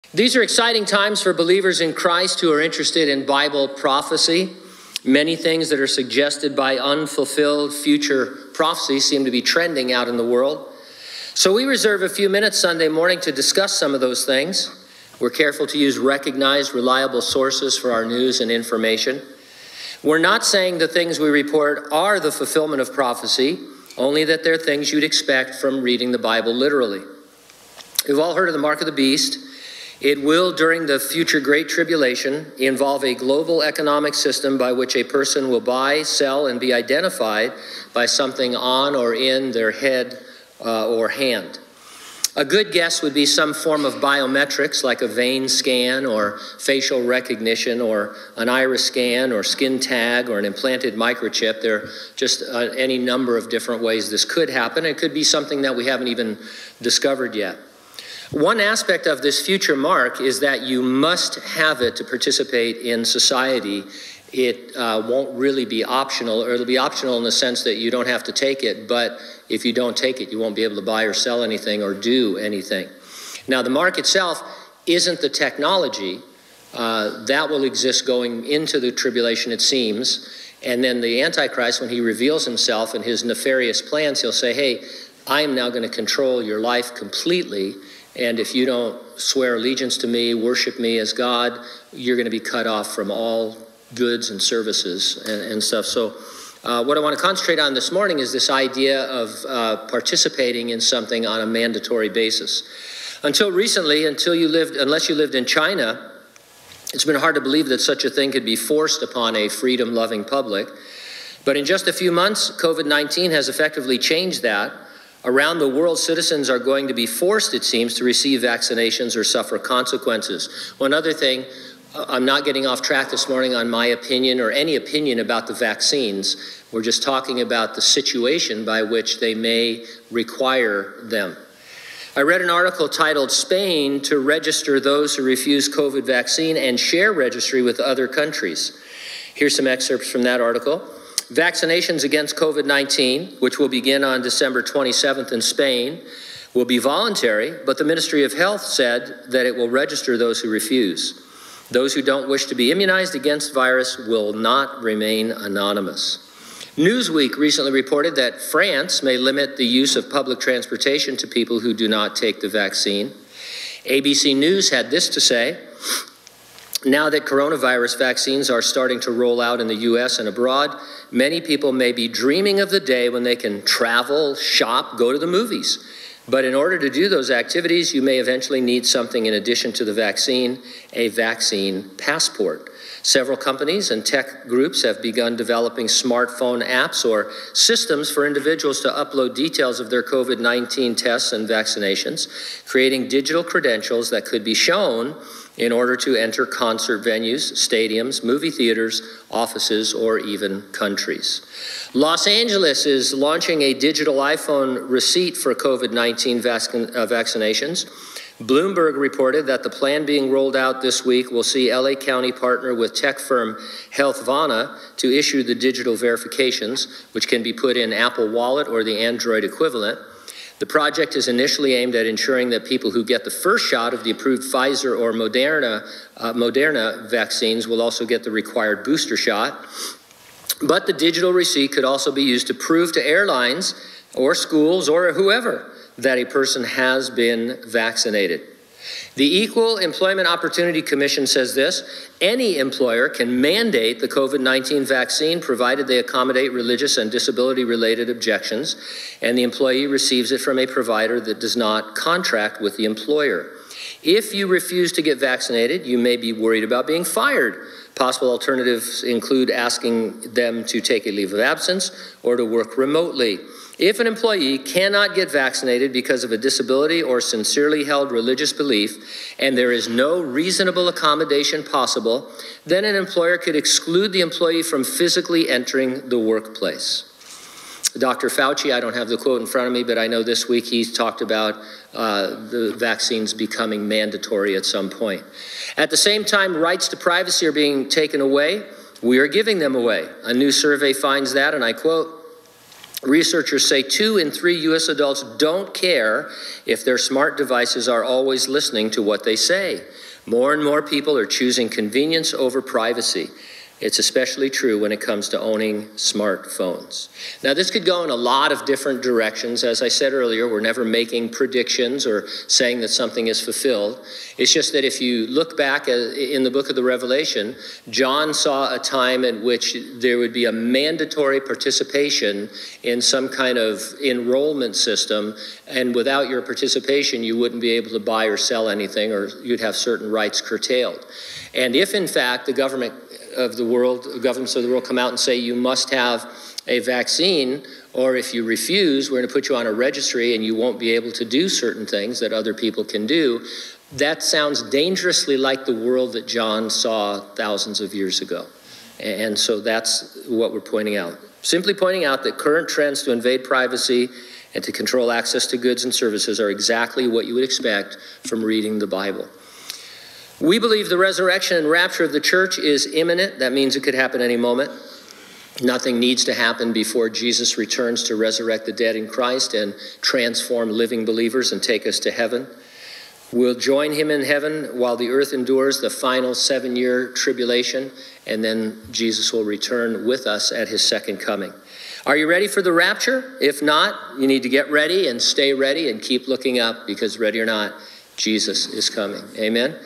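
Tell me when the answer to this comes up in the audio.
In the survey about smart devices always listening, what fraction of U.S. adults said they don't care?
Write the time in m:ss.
4:53.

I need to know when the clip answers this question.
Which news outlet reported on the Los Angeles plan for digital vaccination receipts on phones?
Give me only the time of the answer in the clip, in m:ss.
3:28.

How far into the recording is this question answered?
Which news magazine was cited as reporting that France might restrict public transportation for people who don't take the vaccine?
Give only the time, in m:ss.
2:36.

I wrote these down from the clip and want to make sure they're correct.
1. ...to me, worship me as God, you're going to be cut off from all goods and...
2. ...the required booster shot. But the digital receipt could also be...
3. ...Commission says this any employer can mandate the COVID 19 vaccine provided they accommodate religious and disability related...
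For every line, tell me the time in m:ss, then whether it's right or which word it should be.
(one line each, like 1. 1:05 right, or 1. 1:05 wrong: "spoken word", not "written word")
1. 1:29 right
2. 3:48 right
3. 4:00 right.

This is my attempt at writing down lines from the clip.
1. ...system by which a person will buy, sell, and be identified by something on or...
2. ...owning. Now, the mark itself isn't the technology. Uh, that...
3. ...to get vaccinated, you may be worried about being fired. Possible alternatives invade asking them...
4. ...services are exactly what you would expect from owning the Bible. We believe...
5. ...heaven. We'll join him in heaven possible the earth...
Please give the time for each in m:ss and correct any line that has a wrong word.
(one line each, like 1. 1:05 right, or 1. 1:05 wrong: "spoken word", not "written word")
1. 0:34 right
2. 1:12 wrong: "anything", not "owning"
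3. 4:14 wrong: "include", not "invade"
4. 5:55 wrong: "reading", not "owning"
5. 6:12 wrong: "while", not "possible".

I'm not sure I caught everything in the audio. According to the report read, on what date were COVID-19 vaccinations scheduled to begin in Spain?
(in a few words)
December 27th.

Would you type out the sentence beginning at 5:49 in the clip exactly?
And so that's what we're pointing out.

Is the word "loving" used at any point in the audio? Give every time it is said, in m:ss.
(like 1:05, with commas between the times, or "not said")
1:49.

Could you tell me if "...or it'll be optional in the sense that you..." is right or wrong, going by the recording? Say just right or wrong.
right.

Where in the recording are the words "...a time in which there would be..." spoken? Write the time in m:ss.
5:18.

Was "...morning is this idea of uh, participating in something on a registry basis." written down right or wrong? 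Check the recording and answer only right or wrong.
wrong.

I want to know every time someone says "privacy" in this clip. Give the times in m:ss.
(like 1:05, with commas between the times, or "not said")
4:46, 5:02, 5:53.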